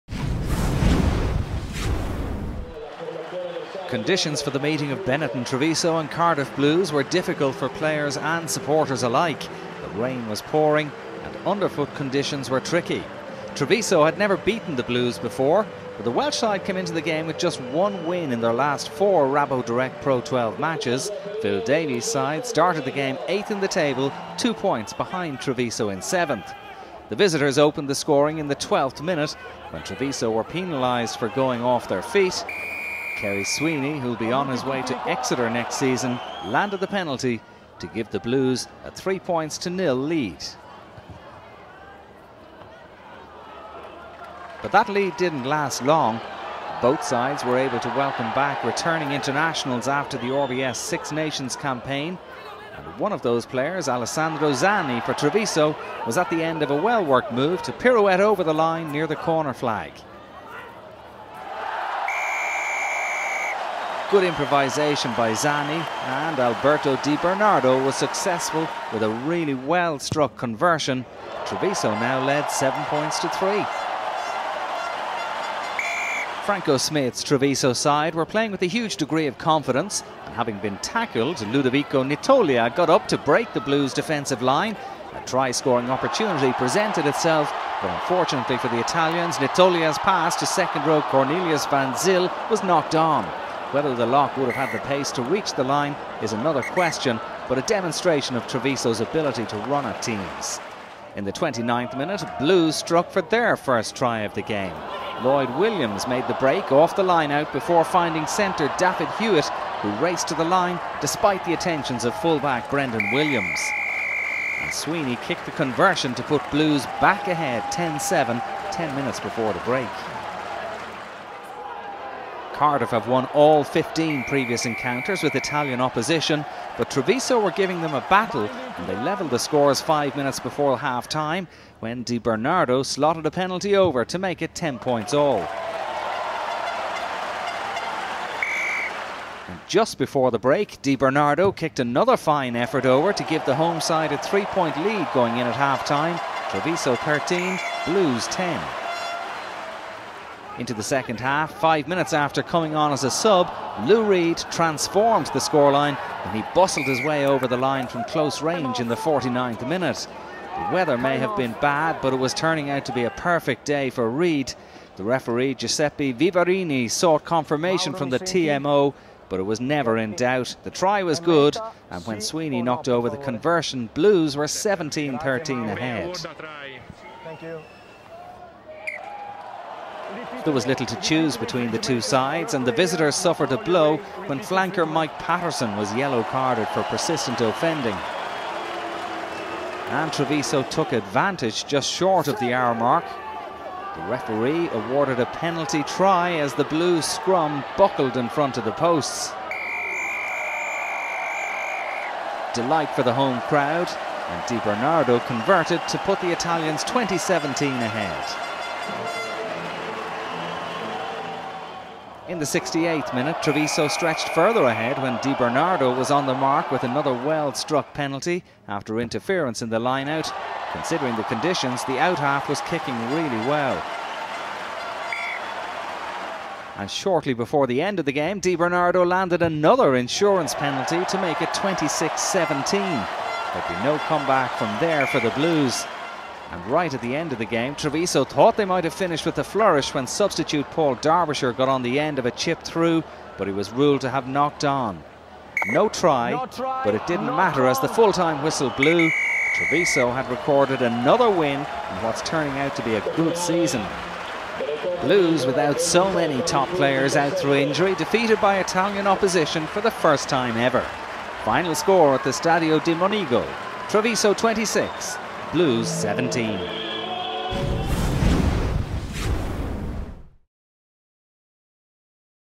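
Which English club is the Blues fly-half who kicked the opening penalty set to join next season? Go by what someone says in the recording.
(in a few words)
Exeter.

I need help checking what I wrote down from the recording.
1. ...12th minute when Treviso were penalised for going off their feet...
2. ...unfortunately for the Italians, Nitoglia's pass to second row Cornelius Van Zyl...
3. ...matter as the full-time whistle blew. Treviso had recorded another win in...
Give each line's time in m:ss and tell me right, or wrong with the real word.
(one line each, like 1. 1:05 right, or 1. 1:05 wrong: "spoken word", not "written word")
1. 0:28 right
2. 1:27 right
3. 4:07 right.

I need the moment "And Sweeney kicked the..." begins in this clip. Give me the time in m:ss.
1:54.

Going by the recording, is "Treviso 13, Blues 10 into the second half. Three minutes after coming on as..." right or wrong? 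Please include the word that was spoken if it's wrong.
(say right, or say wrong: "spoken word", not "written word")
wrong: "Five", not "Three".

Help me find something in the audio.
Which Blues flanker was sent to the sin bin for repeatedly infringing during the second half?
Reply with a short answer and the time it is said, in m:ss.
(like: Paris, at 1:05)
Mike Paterson, at 3:04.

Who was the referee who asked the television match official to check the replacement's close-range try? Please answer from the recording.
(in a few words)
Giuseppe Vivarini.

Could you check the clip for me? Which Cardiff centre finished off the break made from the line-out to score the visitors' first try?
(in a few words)
Dafydd Hewitt.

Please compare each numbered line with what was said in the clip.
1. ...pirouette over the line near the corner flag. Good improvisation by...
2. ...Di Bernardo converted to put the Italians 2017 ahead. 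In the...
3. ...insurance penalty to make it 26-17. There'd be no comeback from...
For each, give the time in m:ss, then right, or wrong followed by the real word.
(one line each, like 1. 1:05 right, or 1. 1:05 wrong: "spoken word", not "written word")
1. 0:57 right
2. 3:24 right
3. 3:49 right.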